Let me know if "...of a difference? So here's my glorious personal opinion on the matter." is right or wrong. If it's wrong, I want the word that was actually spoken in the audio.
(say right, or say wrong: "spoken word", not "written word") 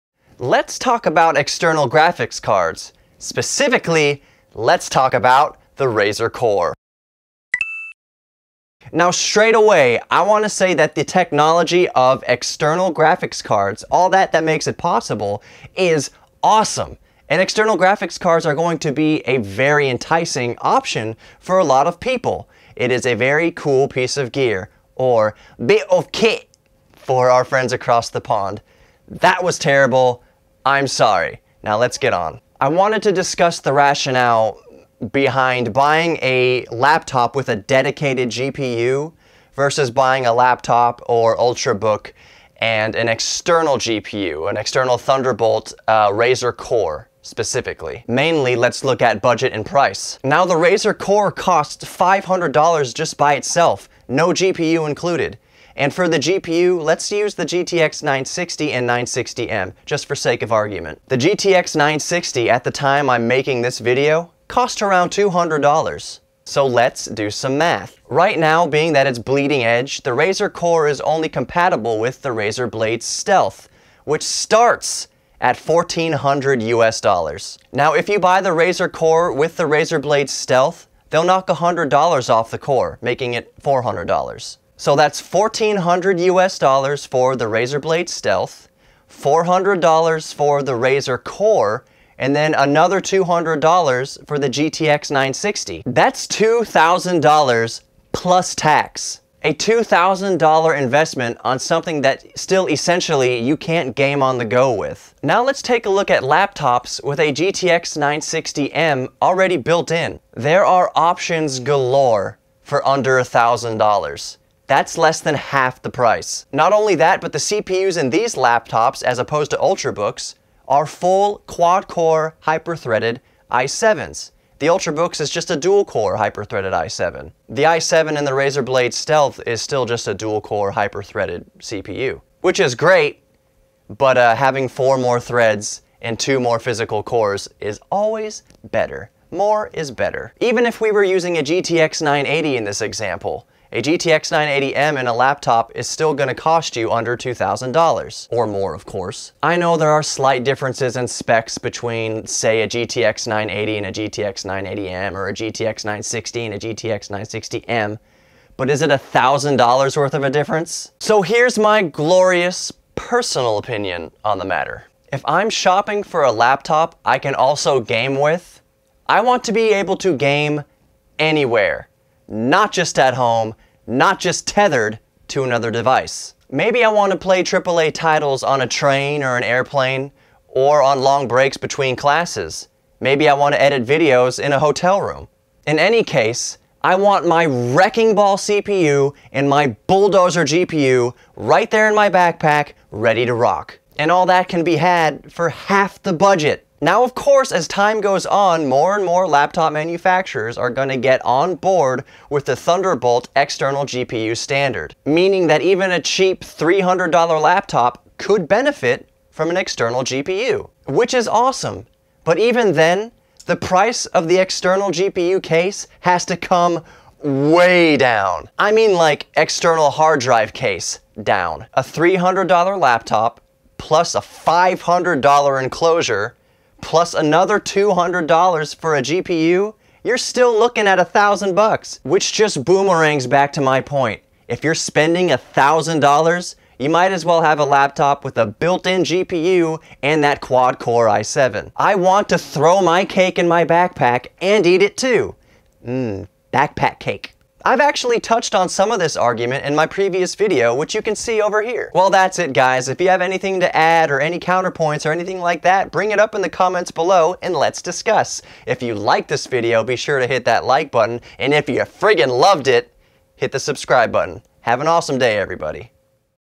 right.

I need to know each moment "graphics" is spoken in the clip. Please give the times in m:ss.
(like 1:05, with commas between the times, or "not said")
0:01, 0:12, 0:17.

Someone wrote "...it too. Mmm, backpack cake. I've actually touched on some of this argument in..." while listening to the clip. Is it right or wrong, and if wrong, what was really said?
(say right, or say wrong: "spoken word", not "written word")
right.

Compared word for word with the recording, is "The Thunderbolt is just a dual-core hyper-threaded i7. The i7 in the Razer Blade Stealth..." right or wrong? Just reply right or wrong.
wrong.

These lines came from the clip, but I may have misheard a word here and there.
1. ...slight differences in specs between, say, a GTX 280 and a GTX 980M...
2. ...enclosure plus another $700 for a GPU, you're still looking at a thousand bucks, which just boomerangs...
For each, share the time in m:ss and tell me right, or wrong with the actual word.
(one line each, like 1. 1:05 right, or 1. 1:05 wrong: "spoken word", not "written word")
1. 2:30 wrong: "980", not "280"
2. 3:45 wrong: "200", not "700".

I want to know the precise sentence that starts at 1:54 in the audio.
That's less than half the price.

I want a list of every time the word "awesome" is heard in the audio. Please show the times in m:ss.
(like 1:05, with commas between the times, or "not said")
0:16, 3:31, 4:24.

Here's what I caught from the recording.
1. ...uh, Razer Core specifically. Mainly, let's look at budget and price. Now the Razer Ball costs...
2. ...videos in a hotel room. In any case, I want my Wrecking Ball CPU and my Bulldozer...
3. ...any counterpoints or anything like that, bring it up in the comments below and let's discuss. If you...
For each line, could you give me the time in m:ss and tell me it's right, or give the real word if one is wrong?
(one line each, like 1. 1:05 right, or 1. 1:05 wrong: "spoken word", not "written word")
1. 0:45 wrong: "Core", not "Ball"
2. 3:03 right
3. 4:14 right.